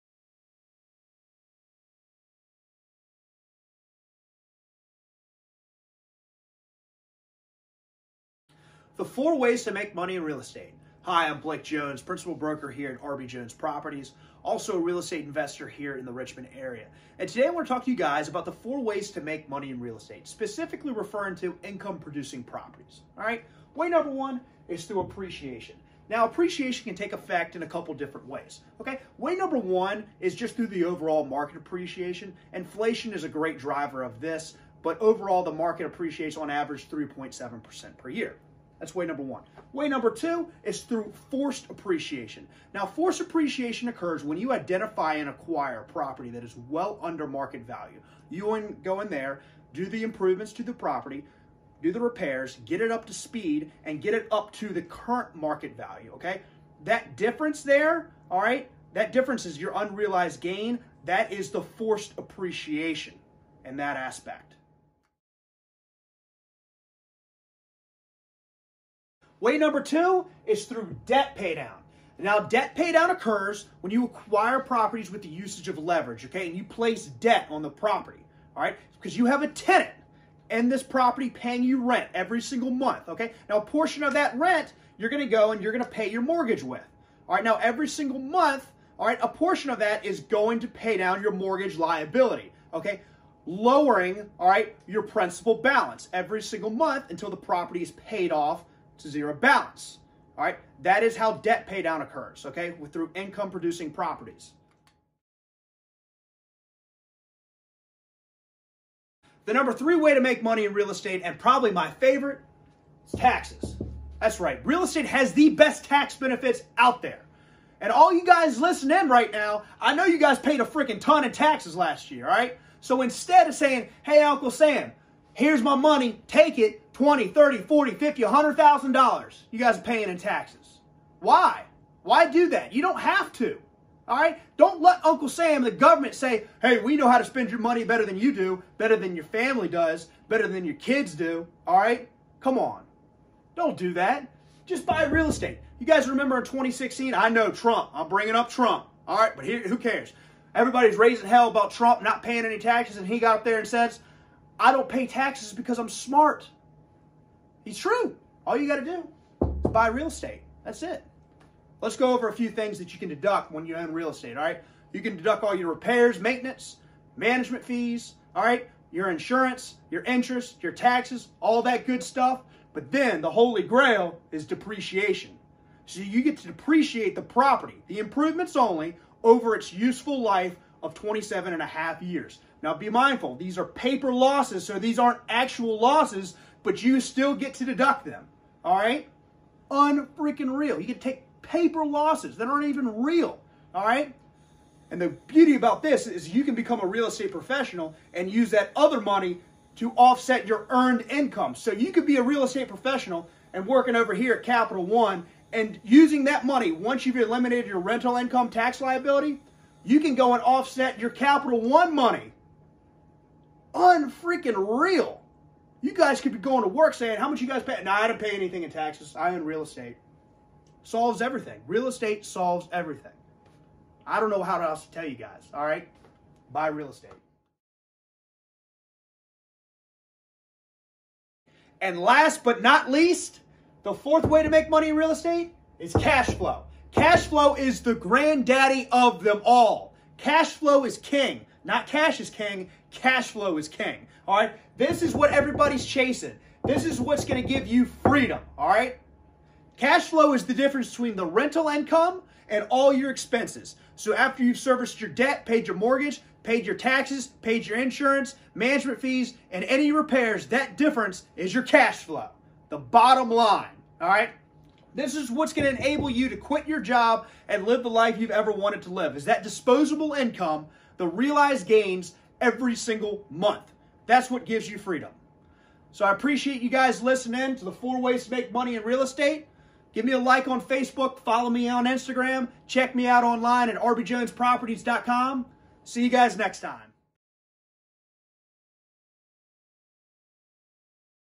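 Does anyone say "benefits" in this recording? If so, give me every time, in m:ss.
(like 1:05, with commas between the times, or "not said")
1:56.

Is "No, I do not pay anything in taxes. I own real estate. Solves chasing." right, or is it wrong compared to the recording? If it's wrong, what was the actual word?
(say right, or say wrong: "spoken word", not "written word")
wrong: "everything", not "chasing".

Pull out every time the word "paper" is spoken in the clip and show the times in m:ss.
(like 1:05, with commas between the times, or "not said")
3:03, 3:11.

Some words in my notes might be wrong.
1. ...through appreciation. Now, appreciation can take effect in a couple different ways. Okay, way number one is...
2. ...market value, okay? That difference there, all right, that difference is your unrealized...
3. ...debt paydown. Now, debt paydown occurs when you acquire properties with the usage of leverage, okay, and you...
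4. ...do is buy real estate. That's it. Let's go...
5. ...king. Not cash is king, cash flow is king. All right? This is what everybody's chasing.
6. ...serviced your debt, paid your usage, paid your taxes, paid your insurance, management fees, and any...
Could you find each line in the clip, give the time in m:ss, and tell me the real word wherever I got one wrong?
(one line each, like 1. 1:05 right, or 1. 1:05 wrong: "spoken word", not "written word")
1. 0:24 right
2. 0:55 right
3. 1:11 right
4. 2:38 right
5. 4:00 right
6. 4:14 wrong: "mortgage", not "usage".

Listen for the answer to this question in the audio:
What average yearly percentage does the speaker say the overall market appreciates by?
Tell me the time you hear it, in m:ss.
0:36.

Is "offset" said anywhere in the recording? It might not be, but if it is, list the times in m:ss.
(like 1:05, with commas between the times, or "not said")
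3:19, 3:30.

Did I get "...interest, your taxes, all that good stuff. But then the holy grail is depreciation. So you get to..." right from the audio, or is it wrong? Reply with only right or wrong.
right.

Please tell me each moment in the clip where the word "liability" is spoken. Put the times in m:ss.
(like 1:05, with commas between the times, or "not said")
1:31, 3:28.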